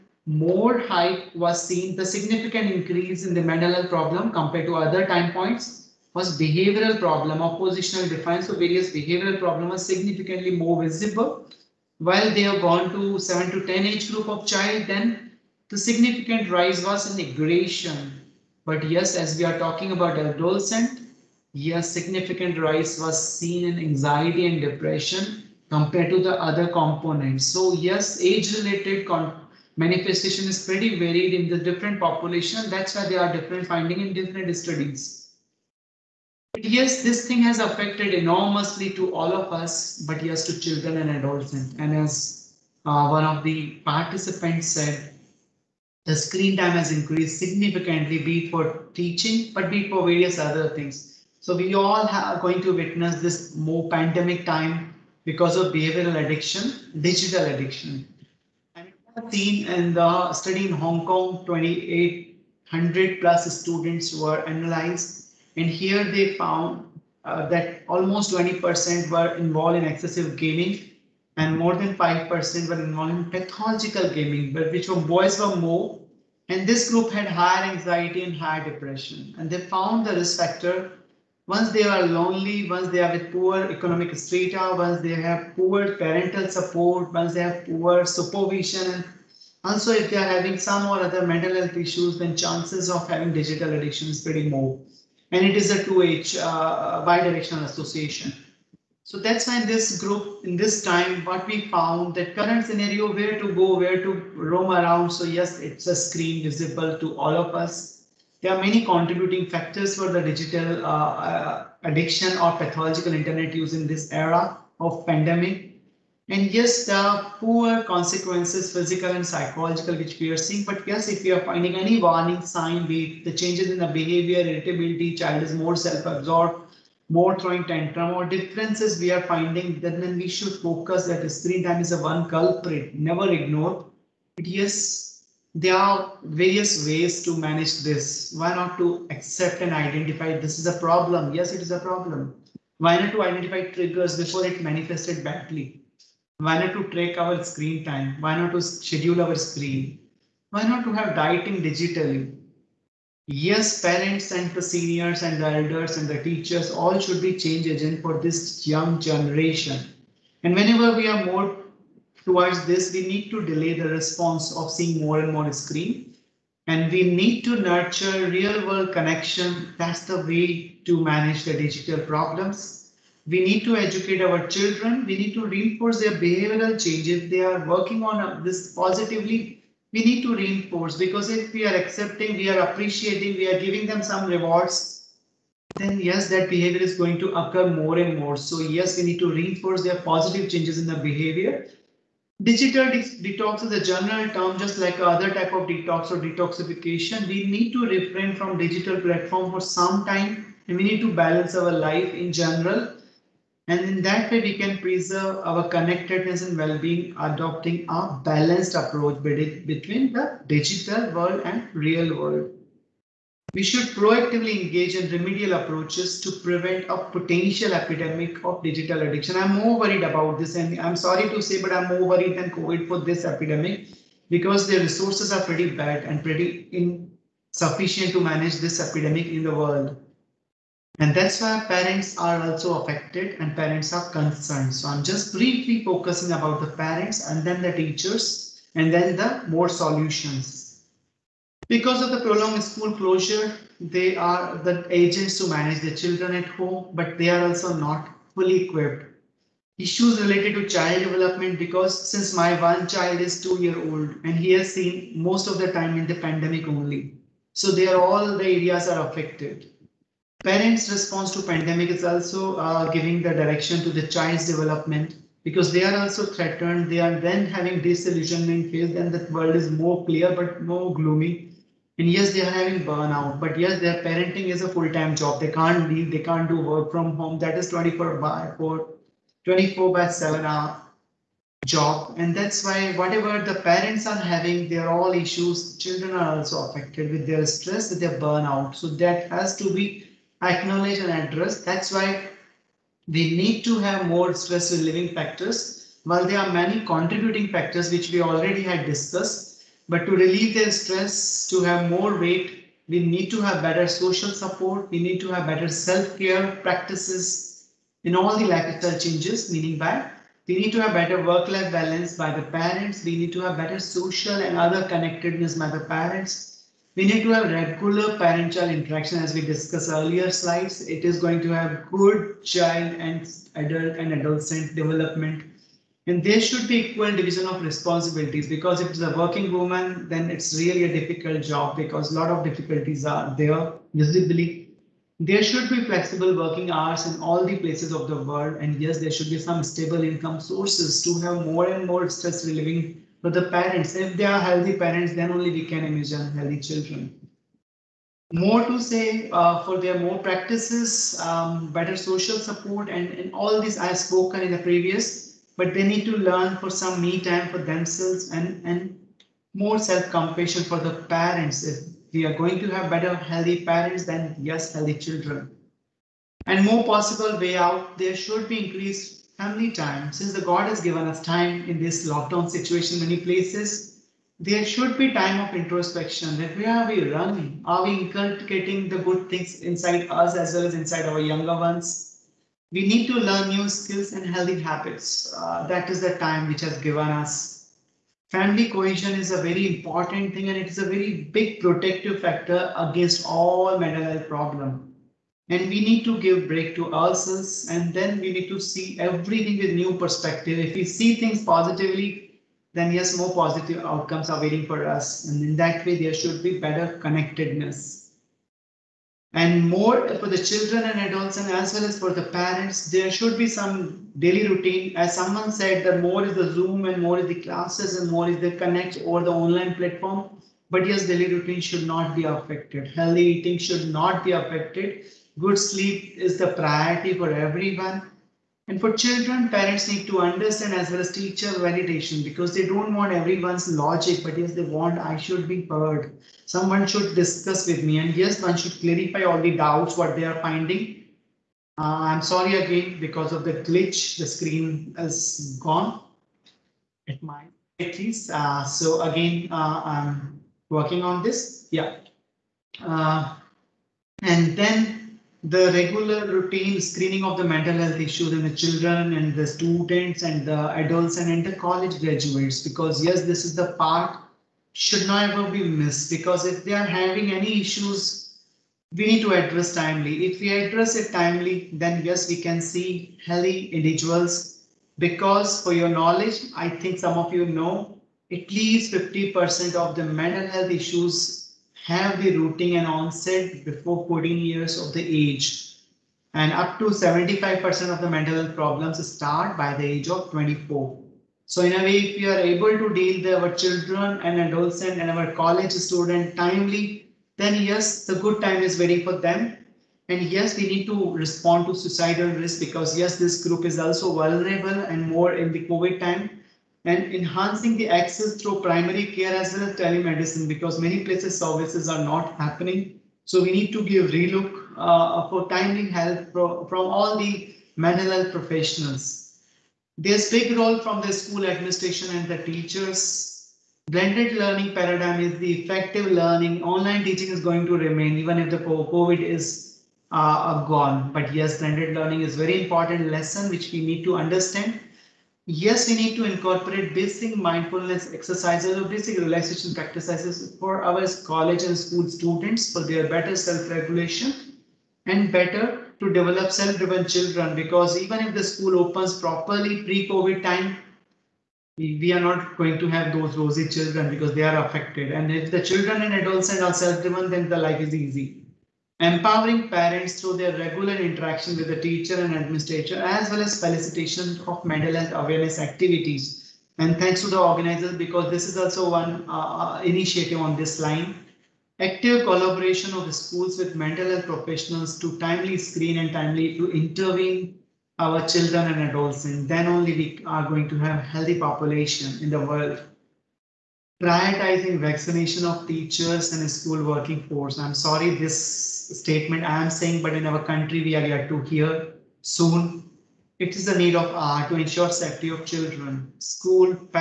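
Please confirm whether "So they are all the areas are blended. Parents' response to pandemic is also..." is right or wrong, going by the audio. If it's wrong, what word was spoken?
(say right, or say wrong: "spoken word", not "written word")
wrong: "affected", not "blended".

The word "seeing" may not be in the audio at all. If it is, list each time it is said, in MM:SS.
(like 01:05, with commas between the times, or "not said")
02:00, 02:44.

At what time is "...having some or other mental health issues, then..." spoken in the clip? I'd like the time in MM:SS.
01:30.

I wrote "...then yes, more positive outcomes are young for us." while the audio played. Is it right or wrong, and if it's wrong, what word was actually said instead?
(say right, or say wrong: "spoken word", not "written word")
wrong: "waiting", not "young".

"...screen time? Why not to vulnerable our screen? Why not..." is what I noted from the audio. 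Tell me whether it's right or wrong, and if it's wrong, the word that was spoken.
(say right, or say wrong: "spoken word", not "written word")
wrong: "schedule", not "vulnerable".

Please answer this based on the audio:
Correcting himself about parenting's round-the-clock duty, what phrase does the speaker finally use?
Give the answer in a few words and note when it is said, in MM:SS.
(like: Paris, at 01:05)
24 by 7, at 04:39.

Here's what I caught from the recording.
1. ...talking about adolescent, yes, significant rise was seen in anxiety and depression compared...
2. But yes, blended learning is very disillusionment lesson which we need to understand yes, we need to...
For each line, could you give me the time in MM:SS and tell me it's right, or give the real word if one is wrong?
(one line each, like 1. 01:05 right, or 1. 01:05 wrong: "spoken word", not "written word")
1. 00:19 right
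2. 08:51 wrong: "important", not "disillusionment".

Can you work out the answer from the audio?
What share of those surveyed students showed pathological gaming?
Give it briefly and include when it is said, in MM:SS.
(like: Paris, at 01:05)
more than 5%, at 01:11.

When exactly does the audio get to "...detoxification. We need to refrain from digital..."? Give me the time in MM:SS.
03:16.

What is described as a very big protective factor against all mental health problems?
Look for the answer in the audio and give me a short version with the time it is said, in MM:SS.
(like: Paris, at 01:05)
Family cohesion, at 06:28.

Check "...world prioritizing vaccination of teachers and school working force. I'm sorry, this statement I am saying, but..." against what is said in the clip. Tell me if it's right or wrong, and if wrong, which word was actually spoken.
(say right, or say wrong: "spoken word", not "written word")
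right.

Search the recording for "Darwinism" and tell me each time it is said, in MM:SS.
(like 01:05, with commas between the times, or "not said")
not said.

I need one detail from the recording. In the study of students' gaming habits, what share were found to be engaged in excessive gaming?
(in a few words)
20%.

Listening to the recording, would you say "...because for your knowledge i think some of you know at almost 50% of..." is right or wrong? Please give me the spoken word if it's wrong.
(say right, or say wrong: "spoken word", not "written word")
wrong: "least", not "almost".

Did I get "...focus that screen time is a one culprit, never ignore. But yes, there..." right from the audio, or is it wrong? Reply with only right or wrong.
right.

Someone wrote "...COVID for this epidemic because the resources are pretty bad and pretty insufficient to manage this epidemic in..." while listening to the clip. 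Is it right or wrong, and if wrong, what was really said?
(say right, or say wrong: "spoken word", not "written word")
right.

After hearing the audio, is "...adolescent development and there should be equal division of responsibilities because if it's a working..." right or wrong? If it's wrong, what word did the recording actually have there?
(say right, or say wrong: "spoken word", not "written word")
right.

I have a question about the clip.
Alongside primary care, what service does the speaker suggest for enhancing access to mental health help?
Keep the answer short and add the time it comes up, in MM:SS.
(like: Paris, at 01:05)
Telemedicine, at 08:29.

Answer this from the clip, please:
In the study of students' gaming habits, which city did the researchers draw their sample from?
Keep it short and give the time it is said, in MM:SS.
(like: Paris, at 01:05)
Hong Kong, at 01:00.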